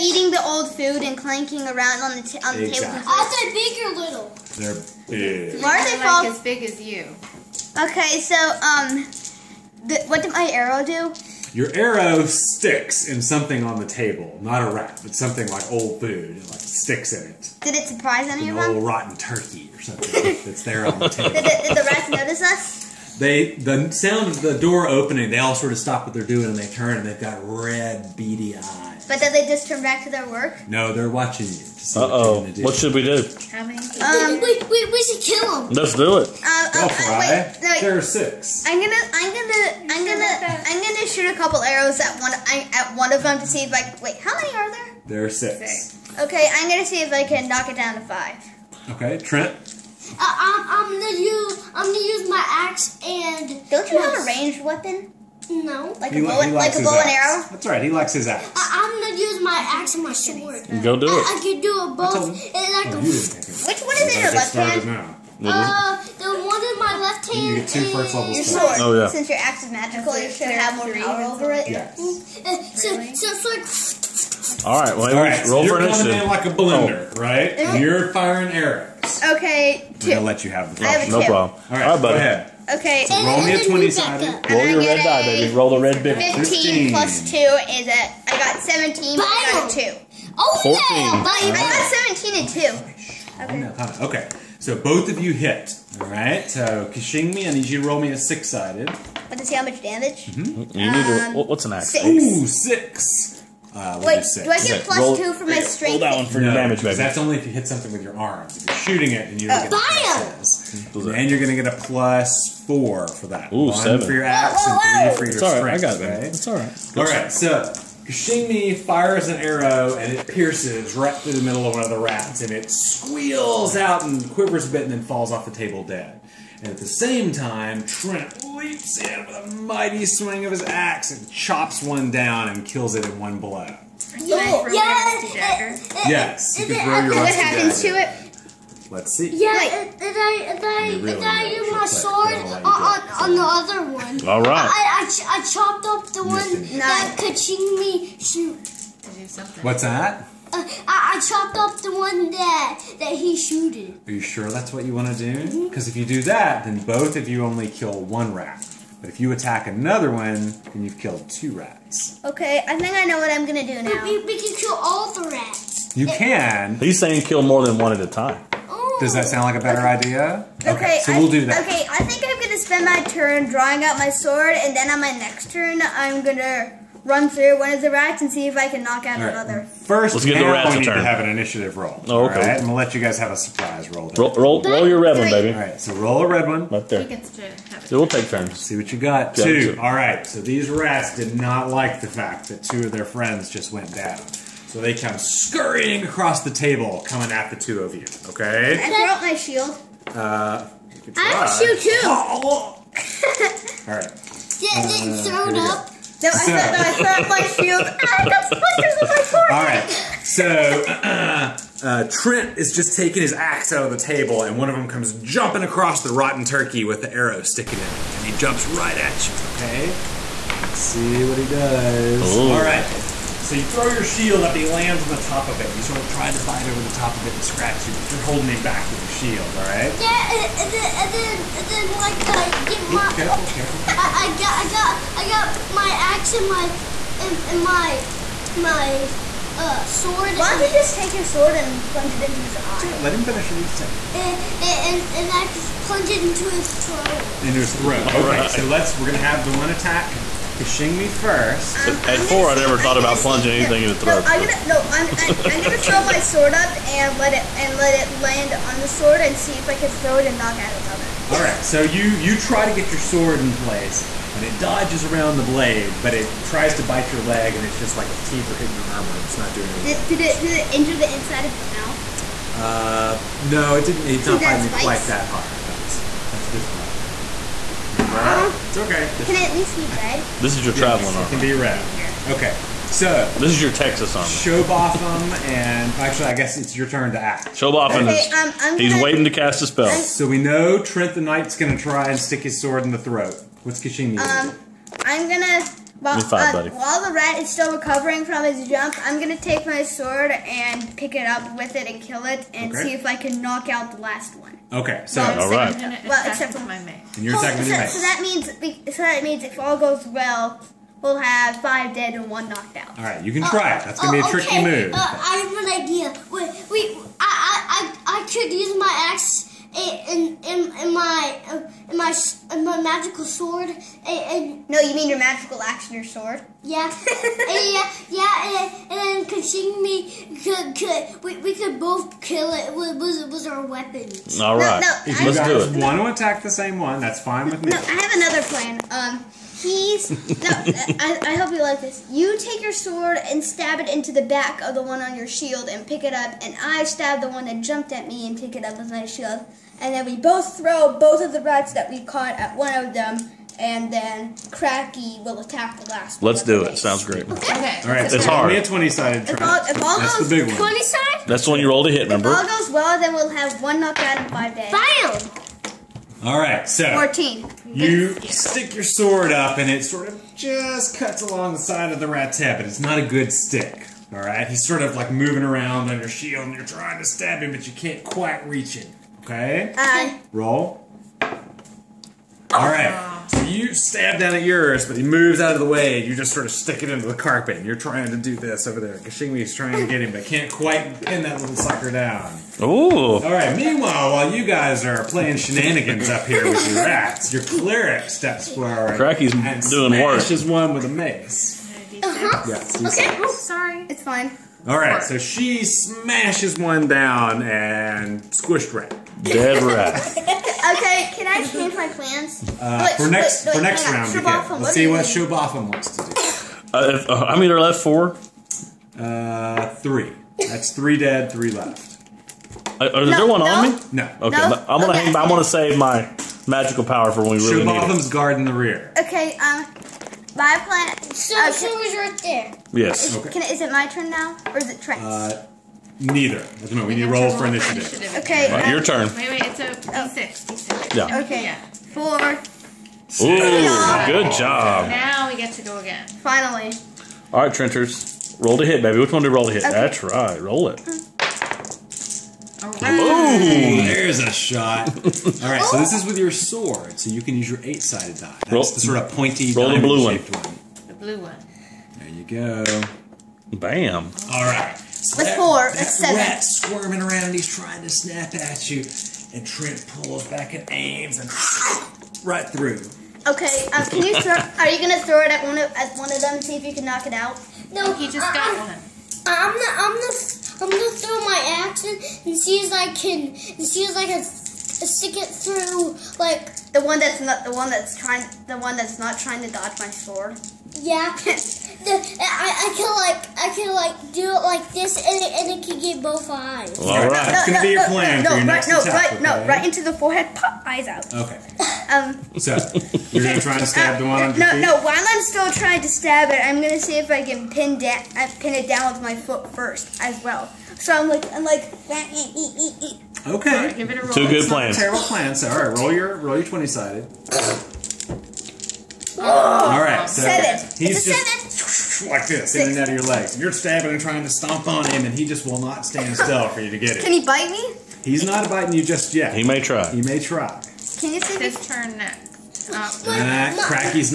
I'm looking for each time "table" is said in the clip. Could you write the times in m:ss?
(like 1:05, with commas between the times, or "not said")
0:02, 0:13, 0:21, 2:05, 3:16, 3:33.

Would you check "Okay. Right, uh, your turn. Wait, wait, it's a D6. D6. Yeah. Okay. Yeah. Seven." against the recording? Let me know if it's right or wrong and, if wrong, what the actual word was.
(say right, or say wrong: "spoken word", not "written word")
wrong: "Four", not "Seven".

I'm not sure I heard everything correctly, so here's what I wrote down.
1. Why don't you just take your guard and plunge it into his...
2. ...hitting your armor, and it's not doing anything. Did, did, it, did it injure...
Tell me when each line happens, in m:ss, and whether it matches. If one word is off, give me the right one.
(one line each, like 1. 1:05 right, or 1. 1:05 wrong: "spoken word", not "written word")
1. 4:00 wrong: "sword", not "guard"
2. 4:28 right.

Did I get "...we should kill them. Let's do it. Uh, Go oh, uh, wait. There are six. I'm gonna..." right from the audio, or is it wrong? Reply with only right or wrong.
right.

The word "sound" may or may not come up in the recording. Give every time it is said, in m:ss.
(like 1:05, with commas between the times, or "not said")
0:23, 2:49, 5:56.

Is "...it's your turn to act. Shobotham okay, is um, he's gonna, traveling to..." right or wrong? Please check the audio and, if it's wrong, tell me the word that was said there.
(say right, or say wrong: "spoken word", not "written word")
wrong: "waiting", not "traveling".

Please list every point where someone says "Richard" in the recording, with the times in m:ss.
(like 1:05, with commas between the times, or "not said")
not said.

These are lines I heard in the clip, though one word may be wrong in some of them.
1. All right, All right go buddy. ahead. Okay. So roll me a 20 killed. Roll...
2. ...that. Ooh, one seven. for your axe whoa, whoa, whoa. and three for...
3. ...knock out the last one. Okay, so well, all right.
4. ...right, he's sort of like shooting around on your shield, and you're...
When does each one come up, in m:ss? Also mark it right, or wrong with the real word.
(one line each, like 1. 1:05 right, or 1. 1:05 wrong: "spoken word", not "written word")
1. 1:21 wrong: "sided", not "killed"
2. 1:53 right
3. 5:03 right
4. 6:14 wrong: "moving", not "shooting".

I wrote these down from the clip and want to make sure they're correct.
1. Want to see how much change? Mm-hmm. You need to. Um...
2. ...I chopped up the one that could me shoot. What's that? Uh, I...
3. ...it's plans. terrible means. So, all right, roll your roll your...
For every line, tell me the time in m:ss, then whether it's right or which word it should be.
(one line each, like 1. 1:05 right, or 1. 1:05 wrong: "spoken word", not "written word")
1. 1:38 wrong: "damage", not "change"
2. 2:25 right
3. 8:34 wrong: "plans", not "means".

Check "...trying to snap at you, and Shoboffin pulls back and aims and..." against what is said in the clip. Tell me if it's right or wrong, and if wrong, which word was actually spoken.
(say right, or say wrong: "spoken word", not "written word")
wrong: "Trent", not "Shoboffin".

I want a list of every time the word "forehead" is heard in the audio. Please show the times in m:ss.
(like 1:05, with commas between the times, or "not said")
3:29, 8:19.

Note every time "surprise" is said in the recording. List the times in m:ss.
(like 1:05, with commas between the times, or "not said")
0:17, 3:03.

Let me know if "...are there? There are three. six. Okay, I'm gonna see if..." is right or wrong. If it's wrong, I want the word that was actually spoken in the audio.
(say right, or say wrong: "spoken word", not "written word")
wrong: "six", not "three".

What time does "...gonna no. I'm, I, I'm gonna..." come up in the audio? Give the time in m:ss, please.
4:14.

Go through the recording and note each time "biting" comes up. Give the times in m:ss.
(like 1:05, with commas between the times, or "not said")
4:34, 8:48.